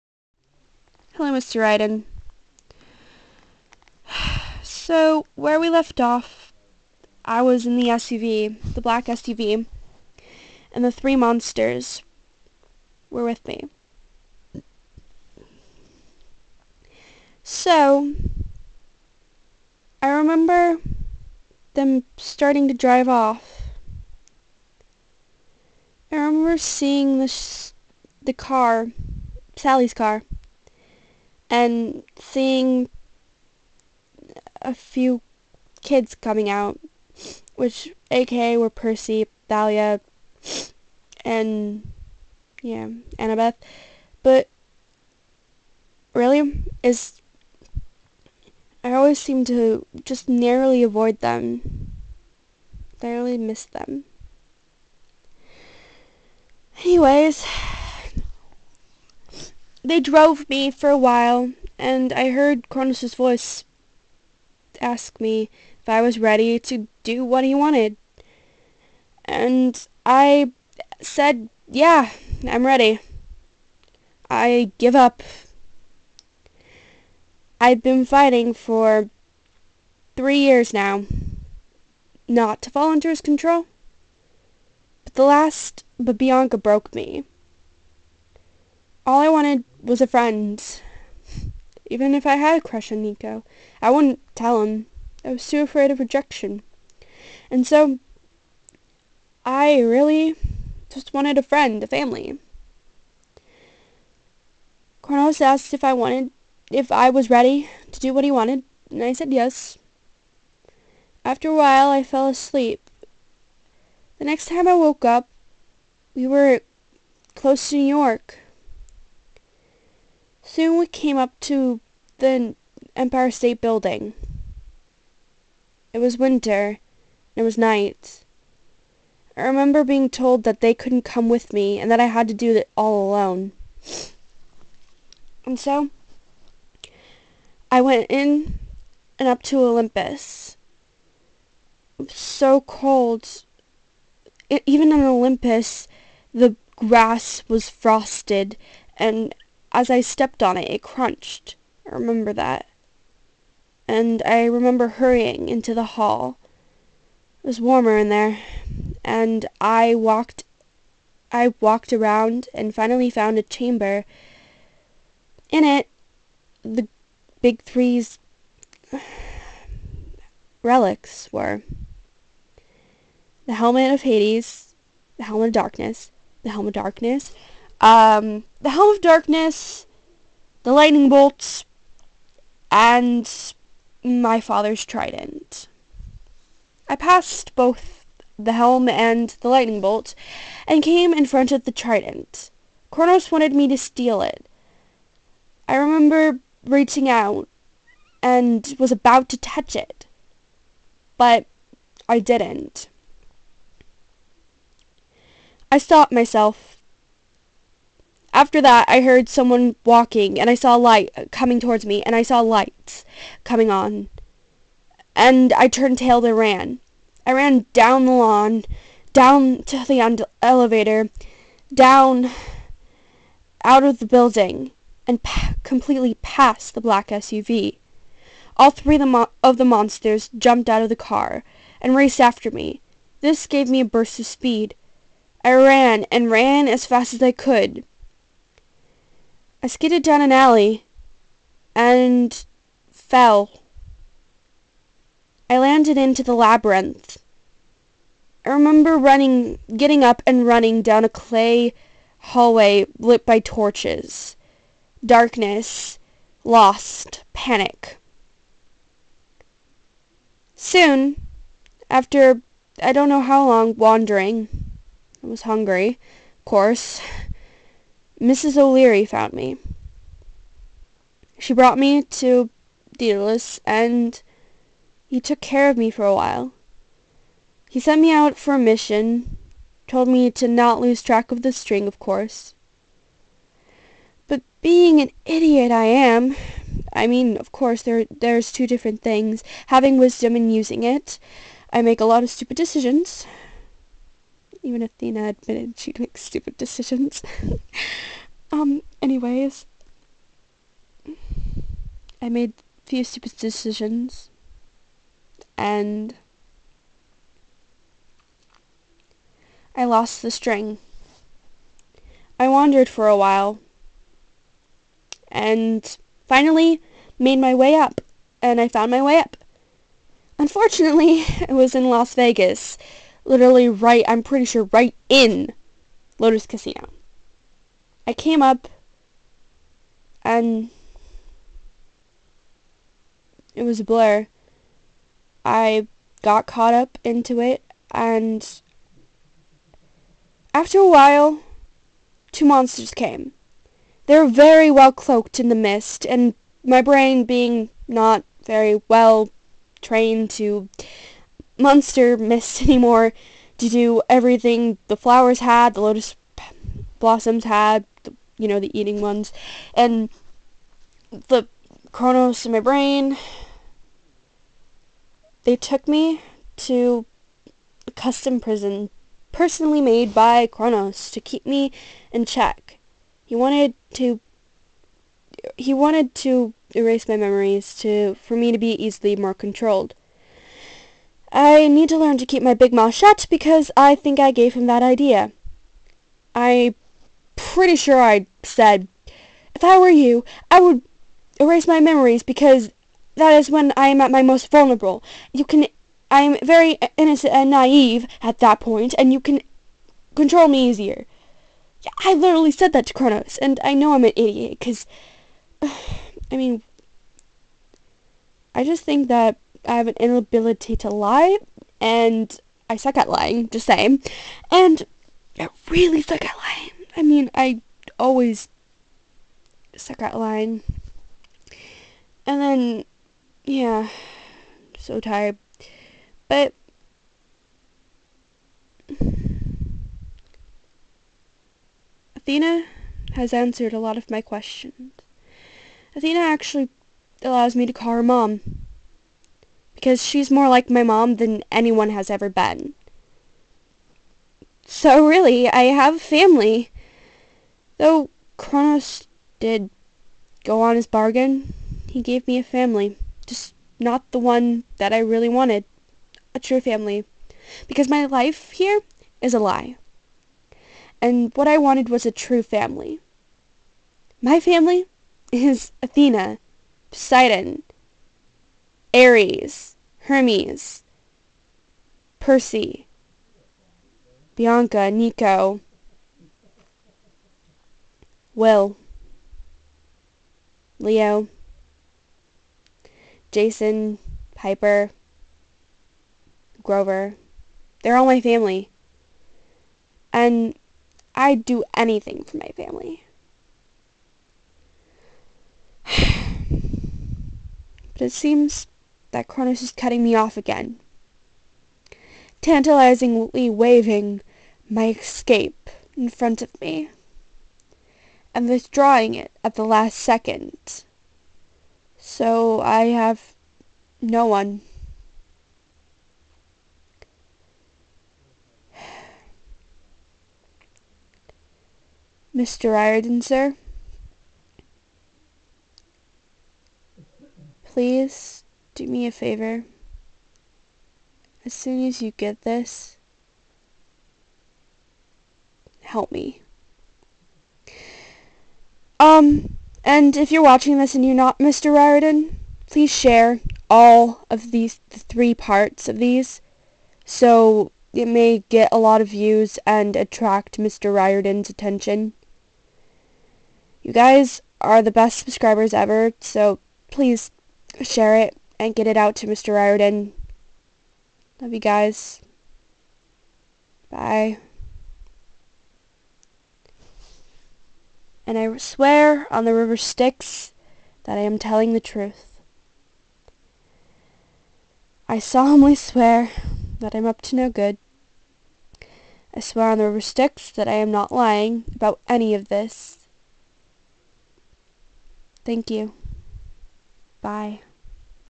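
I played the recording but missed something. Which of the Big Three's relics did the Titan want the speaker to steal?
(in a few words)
The trident.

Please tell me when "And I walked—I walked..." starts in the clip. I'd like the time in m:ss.
2:39.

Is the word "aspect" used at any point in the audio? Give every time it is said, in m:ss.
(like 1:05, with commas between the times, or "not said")
not said.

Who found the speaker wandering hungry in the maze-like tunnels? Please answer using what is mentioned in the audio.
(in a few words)
Mrs. O'Leary.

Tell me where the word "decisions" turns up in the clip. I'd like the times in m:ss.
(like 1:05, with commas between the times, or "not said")
4:52, 4:56, 5:03.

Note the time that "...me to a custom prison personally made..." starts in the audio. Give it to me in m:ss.
6:05.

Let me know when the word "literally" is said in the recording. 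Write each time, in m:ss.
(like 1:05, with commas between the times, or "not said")
5:23, 6:42.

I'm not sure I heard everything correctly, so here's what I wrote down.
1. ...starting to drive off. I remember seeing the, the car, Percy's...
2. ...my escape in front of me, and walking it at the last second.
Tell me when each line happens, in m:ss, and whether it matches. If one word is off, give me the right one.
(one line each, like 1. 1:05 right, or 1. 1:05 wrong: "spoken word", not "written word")
1. 0:22 wrong: "Sally", not "Percy"
2. 8:24 wrong: "withdrawing", not "walking".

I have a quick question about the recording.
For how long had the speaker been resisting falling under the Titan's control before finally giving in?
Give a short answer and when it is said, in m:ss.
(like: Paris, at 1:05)
Three years, at 1:20.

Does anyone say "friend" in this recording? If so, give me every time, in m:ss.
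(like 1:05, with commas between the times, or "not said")
1:30, 1:41.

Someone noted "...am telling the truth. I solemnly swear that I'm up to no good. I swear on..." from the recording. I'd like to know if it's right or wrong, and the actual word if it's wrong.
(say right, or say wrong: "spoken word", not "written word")
right.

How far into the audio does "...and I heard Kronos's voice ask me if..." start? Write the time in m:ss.
1:01.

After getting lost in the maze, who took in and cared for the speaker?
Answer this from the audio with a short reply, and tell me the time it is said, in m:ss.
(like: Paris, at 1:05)
Daedalus, at 4:32.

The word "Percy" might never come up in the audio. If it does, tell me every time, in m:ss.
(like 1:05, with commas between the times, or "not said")
0:38, 7:52.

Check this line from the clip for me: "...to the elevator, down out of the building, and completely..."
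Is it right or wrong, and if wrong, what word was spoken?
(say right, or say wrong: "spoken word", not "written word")
right.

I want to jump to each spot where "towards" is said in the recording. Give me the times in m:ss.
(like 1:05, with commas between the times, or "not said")
3:31.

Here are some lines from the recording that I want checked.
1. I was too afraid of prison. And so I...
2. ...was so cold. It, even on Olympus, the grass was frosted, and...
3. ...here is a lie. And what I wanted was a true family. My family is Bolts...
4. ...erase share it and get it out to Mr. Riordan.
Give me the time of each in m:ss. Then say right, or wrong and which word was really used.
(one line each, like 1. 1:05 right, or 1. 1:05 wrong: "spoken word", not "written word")
1. 1:35 wrong: "rejection", not "prison"
2. 2:22 right
3. 7:38 wrong: "Athena", not "Bolts"
4. 9:16 wrong: "please", not "erase".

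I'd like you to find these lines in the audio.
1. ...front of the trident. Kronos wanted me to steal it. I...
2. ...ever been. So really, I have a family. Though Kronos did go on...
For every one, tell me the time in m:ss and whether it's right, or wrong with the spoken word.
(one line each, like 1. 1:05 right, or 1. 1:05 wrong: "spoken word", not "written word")
1. 3:11 right
2. 7:22 right.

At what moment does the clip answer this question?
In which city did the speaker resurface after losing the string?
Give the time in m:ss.
5:21.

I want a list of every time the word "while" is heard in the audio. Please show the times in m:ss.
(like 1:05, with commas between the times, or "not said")
1:00, 1:51, 4:36, 5:13, 5:40.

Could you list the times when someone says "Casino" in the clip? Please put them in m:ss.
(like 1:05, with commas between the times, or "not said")
5:26.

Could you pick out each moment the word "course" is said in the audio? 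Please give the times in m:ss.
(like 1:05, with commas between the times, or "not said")
4:26, 4:41, 4:47.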